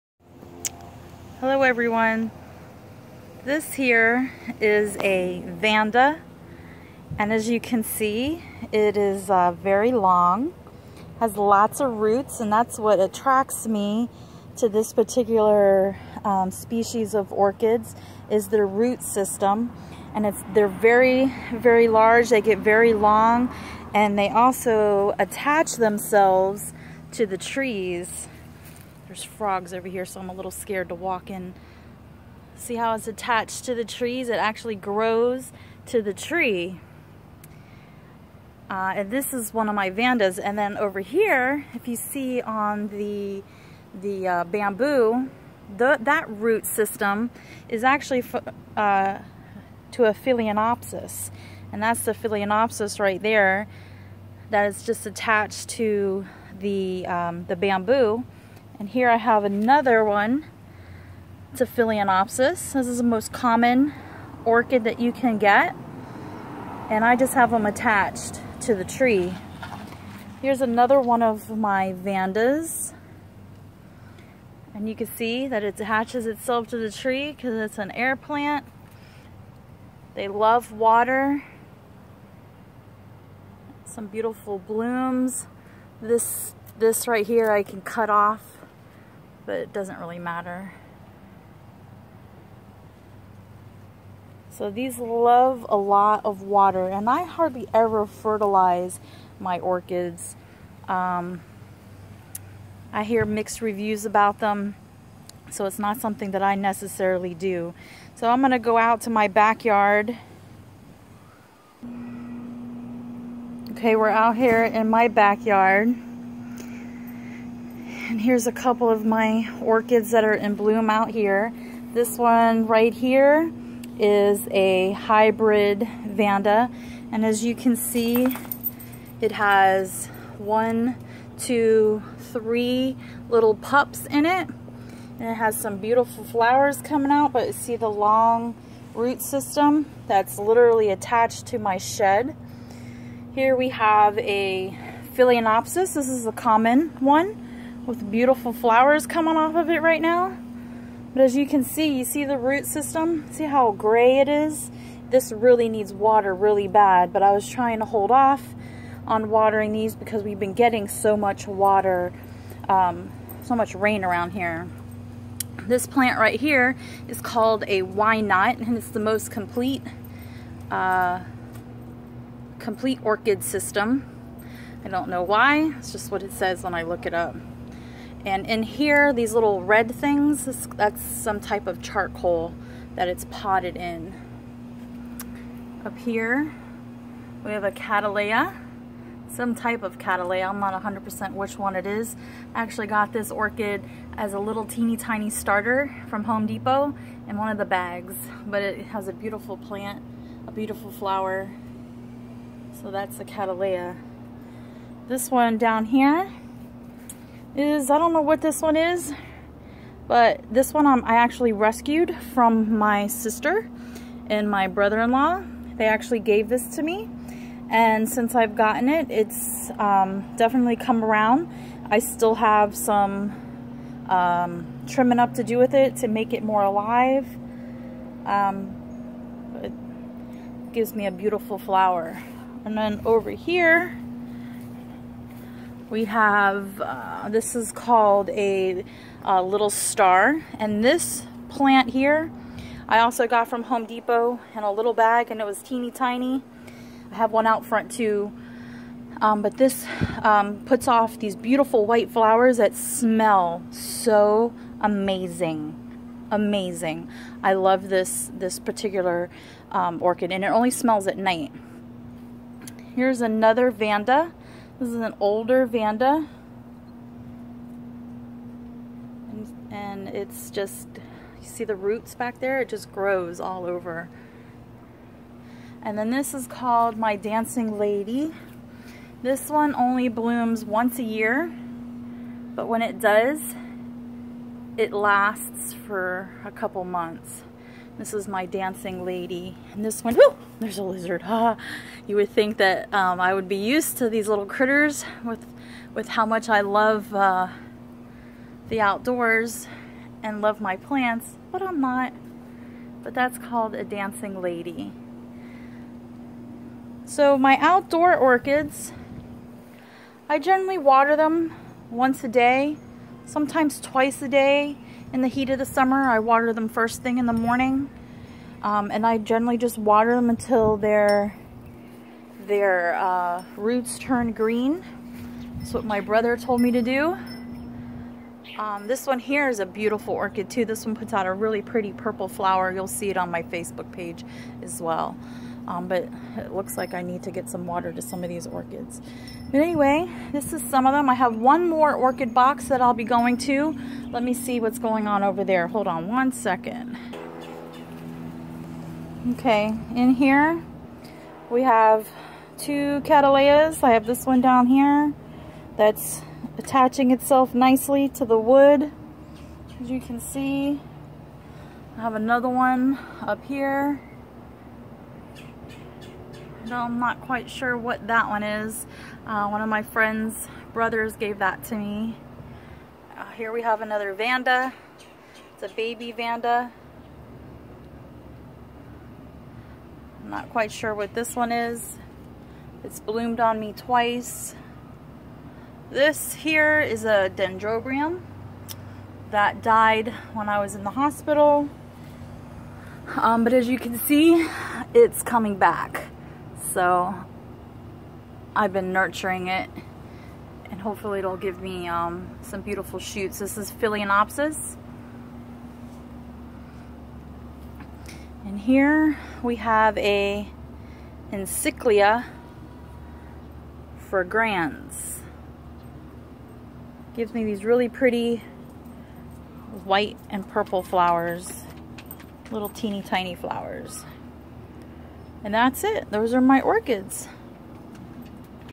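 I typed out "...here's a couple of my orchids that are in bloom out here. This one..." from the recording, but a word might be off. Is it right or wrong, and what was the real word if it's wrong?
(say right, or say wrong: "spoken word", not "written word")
right.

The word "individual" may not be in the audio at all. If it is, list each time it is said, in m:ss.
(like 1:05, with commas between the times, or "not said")
not said.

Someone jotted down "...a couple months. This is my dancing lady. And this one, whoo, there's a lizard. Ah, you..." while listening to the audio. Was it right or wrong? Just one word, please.
right.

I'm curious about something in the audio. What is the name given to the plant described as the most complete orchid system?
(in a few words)
Why not.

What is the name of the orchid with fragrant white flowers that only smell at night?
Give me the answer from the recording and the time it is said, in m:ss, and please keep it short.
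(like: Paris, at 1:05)
Little star, at 3:59.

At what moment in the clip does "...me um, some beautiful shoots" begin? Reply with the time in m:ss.
6:41.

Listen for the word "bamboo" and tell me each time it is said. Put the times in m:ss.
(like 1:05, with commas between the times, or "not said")
0:44, 0:57.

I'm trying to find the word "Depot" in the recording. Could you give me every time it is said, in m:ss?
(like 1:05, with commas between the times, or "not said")
3:16, 4:03.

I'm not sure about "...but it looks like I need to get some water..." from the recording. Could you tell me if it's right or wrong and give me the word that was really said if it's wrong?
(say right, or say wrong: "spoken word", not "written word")
right.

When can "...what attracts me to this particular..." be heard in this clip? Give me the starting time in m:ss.
0:12.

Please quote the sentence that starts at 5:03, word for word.
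But that's called a dancing lady.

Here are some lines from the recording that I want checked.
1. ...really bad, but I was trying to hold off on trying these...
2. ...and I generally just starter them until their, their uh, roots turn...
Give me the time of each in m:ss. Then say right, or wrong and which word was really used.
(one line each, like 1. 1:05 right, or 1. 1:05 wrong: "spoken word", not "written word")
1. 2:36 wrong: "watering", not "trying"
2. 5:18 wrong: "water", not "starter".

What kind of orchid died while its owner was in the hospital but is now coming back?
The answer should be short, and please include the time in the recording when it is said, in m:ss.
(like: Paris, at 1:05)
Dendrobium, at 6:27.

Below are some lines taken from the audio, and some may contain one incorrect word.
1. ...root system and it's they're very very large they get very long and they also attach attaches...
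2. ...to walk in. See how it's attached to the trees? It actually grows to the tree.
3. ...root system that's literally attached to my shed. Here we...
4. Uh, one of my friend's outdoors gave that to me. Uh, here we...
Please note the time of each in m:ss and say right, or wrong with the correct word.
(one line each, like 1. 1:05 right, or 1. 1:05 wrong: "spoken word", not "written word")
1. 0:18 wrong: "themselves", not "attaches"
2. 0:30 right
3. 2:18 right
4. 6:09 wrong: "brothers", not "outdoors".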